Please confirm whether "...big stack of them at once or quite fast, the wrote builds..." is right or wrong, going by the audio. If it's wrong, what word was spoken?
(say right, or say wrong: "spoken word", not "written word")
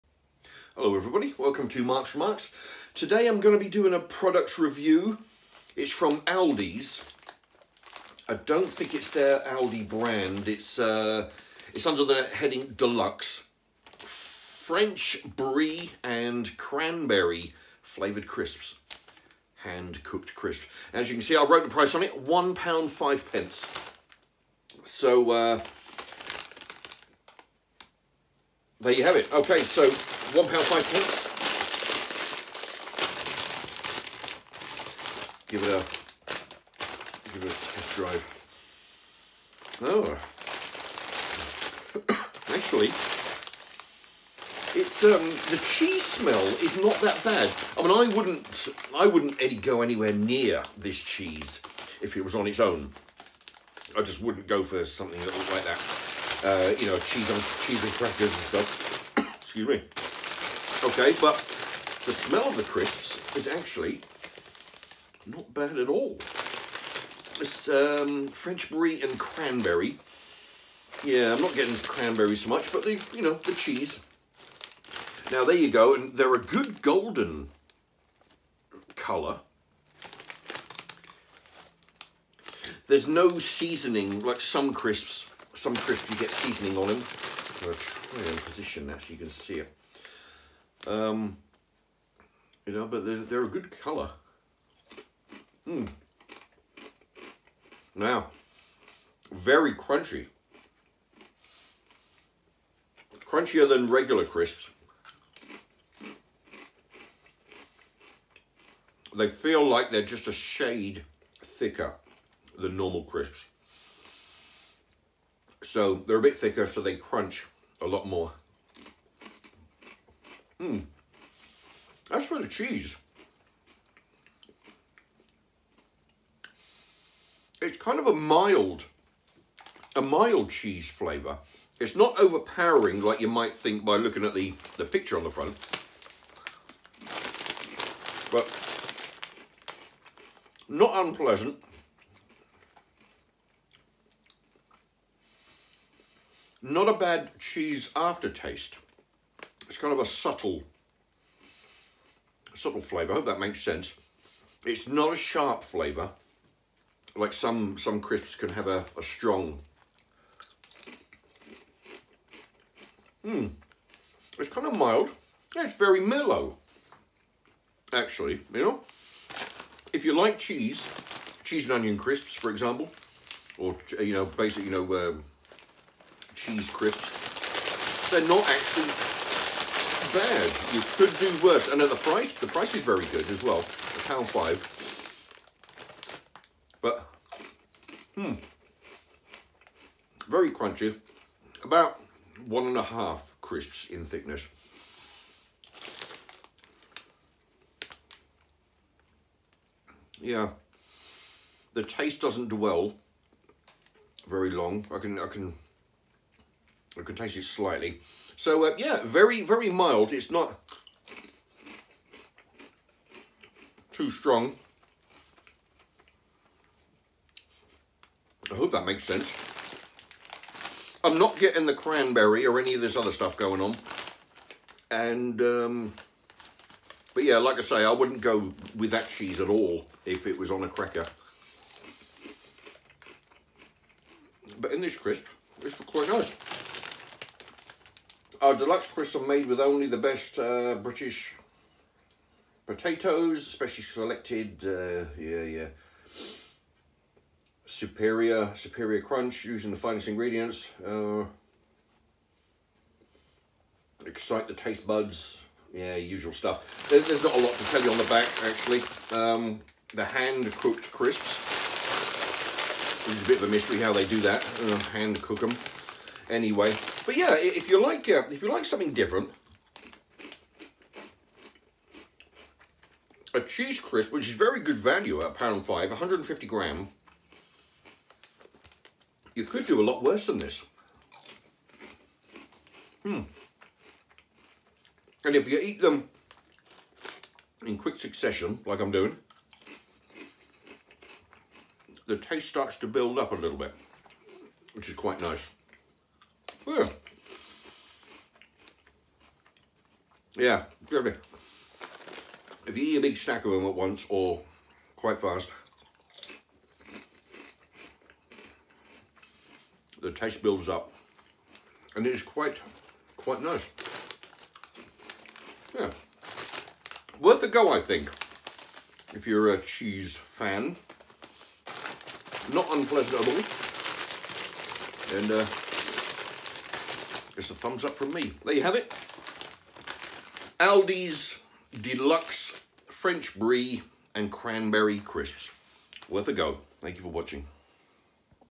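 wrong: "taste", not "wrote".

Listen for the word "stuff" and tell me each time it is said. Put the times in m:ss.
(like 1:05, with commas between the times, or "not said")
0:58, 3:43, 4:16.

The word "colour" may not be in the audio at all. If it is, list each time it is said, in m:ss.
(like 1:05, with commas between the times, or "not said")
1:18, 1:33.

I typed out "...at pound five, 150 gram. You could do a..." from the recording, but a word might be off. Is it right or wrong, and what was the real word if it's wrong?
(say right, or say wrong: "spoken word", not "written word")
right.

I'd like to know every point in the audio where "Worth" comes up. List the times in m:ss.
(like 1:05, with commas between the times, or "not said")
5:17, 5:36.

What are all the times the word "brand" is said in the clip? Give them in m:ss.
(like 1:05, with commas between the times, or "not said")
0:09.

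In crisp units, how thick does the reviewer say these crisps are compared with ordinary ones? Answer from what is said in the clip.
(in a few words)
1.5 crisps.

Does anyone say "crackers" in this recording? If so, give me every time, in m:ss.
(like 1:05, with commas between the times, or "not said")
0:57, 3:50.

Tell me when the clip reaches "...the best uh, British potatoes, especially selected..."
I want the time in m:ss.
3:59.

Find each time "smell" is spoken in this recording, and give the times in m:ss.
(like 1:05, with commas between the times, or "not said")
0:46, 1:02.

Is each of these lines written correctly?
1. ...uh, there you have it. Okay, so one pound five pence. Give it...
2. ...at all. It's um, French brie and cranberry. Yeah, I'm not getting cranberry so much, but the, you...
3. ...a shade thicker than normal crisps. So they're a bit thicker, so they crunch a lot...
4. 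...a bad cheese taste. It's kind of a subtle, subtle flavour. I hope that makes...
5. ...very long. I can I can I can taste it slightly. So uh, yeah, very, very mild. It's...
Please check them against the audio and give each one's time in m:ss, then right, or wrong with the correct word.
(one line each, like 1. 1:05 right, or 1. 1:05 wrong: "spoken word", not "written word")
1. 0:25 right
2. 1:05 right
3. 1:50 right
4. 2:26 wrong: "aftertaste", not "taste"
5. 3:24 right.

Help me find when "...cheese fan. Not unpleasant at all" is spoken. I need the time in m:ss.
5:19.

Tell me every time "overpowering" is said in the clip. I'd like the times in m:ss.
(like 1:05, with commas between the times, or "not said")
2:12.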